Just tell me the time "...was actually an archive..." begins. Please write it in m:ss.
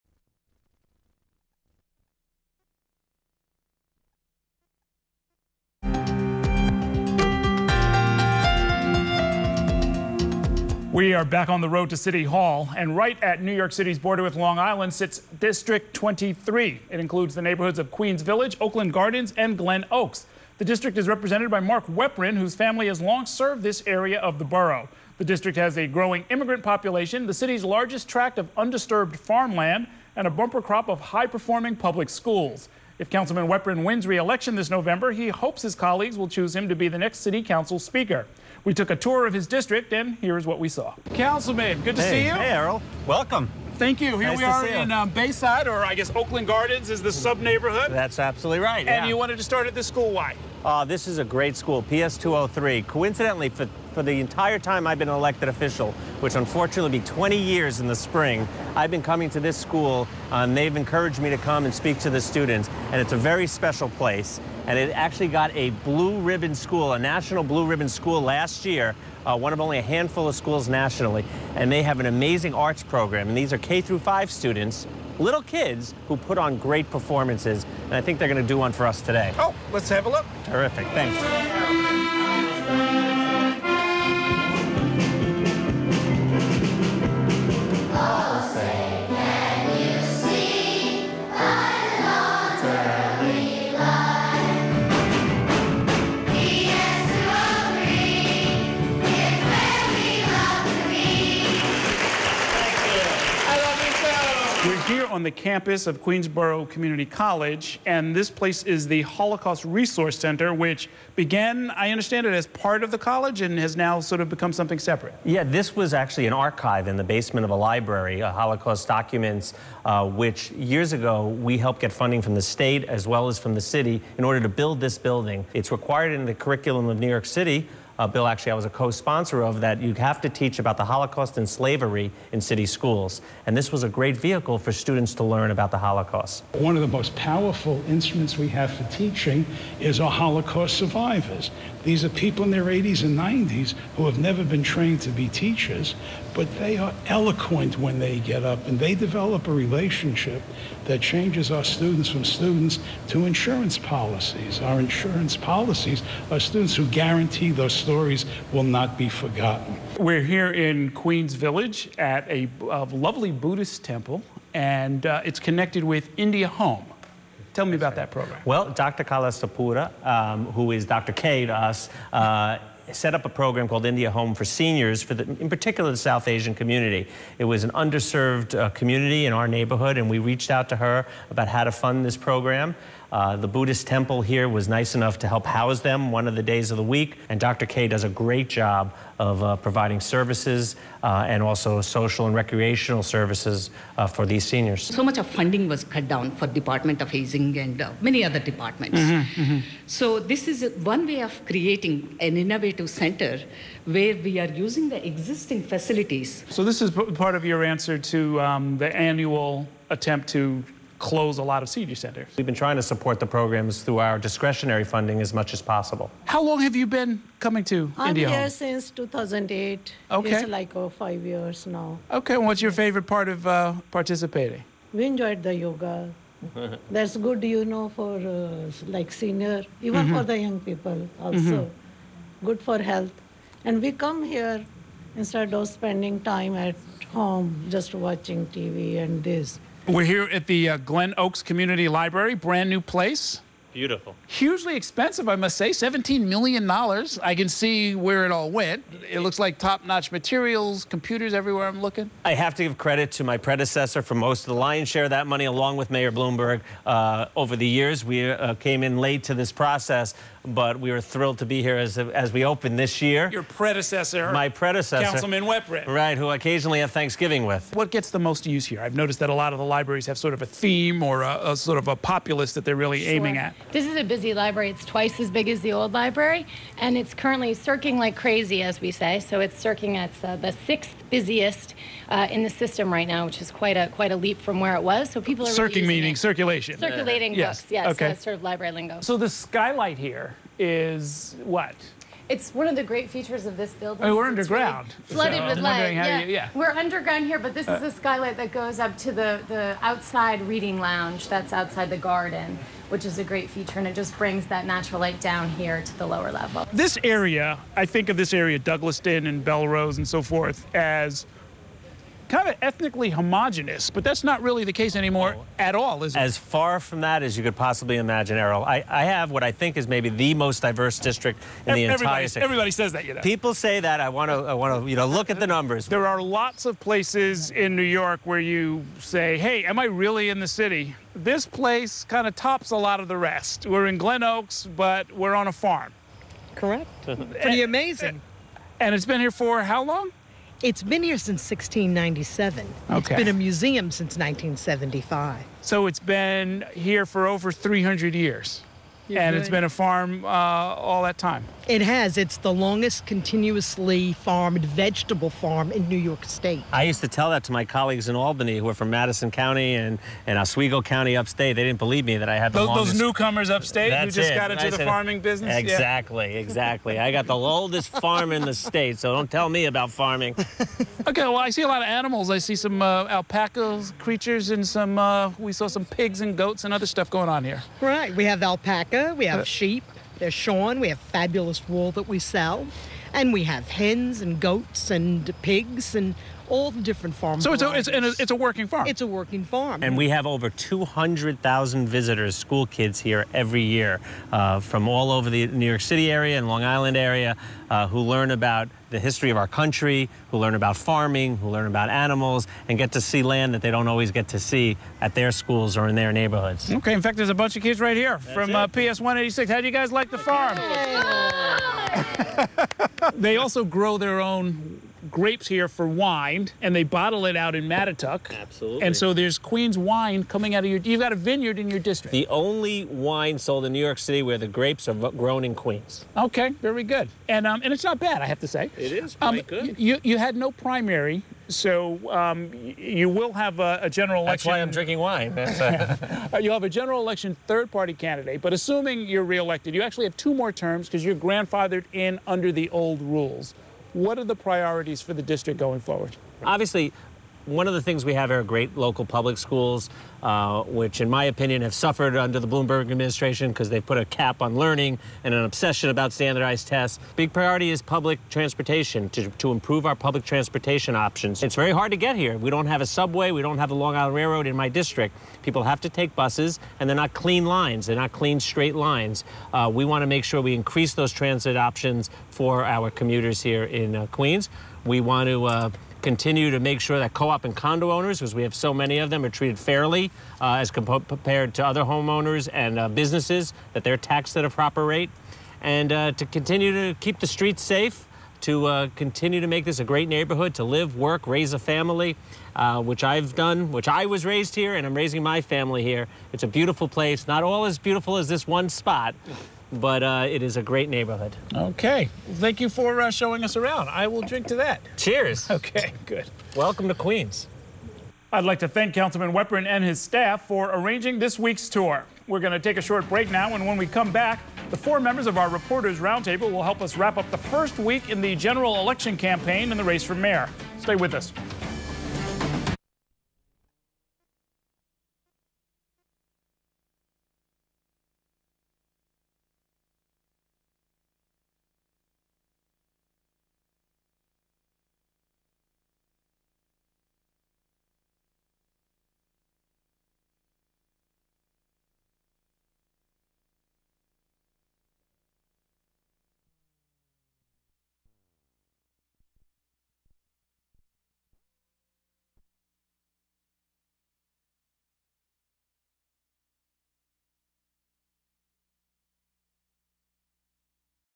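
1:55.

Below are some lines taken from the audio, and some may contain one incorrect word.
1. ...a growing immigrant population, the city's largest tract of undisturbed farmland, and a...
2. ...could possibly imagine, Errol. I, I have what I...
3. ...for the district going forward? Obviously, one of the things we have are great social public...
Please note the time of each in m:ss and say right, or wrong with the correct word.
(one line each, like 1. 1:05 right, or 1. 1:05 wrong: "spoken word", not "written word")
1. 0:25 right
2. 5:17 right
3. 7:25 wrong: "local", not "social".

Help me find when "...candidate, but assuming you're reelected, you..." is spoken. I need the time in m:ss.
7:17.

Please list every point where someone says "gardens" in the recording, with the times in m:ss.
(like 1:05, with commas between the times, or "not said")
0:18, 0:46, 5:01.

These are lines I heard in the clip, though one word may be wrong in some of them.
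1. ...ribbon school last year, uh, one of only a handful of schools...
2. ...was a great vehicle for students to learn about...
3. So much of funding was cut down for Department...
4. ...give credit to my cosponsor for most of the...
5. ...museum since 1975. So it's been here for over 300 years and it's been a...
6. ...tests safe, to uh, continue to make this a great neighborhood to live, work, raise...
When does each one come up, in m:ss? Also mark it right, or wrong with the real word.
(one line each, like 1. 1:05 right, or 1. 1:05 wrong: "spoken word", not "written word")
1. 1:07 right
2. 2:13 right
3. 3:14 right
4. 4:12 wrong: "predecessor", not "cosponsor"
5. 5:43 right
6. 8:07 wrong: "streets", not "tests".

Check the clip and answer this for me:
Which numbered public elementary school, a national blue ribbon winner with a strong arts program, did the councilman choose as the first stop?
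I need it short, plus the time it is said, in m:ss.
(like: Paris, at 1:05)
PS 203, at 0:51.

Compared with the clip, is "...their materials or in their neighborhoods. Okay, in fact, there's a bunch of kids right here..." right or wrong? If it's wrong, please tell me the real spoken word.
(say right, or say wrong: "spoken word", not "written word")
wrong: "schools", not "materials".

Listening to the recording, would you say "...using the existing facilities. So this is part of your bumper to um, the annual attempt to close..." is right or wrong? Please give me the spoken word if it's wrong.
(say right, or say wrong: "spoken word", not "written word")
wrong: "answer", not "bumper".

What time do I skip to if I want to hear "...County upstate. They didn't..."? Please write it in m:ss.
6:00.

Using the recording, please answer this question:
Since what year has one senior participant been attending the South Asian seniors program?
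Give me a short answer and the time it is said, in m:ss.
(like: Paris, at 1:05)
2008, at 3:38.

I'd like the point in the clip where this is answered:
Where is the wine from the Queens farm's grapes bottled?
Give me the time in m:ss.
6:57.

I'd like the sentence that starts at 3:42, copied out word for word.
Okay, and what's your favorite part of uh, participating?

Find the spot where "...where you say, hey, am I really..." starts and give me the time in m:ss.
5:28.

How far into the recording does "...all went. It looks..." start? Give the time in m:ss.
4:08.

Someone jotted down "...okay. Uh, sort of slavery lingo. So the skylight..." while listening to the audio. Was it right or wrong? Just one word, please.
wrong.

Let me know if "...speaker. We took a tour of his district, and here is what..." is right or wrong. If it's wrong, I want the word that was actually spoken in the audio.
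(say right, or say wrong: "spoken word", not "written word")
right.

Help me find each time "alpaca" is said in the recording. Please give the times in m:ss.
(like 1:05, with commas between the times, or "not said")
6:13, 6:18.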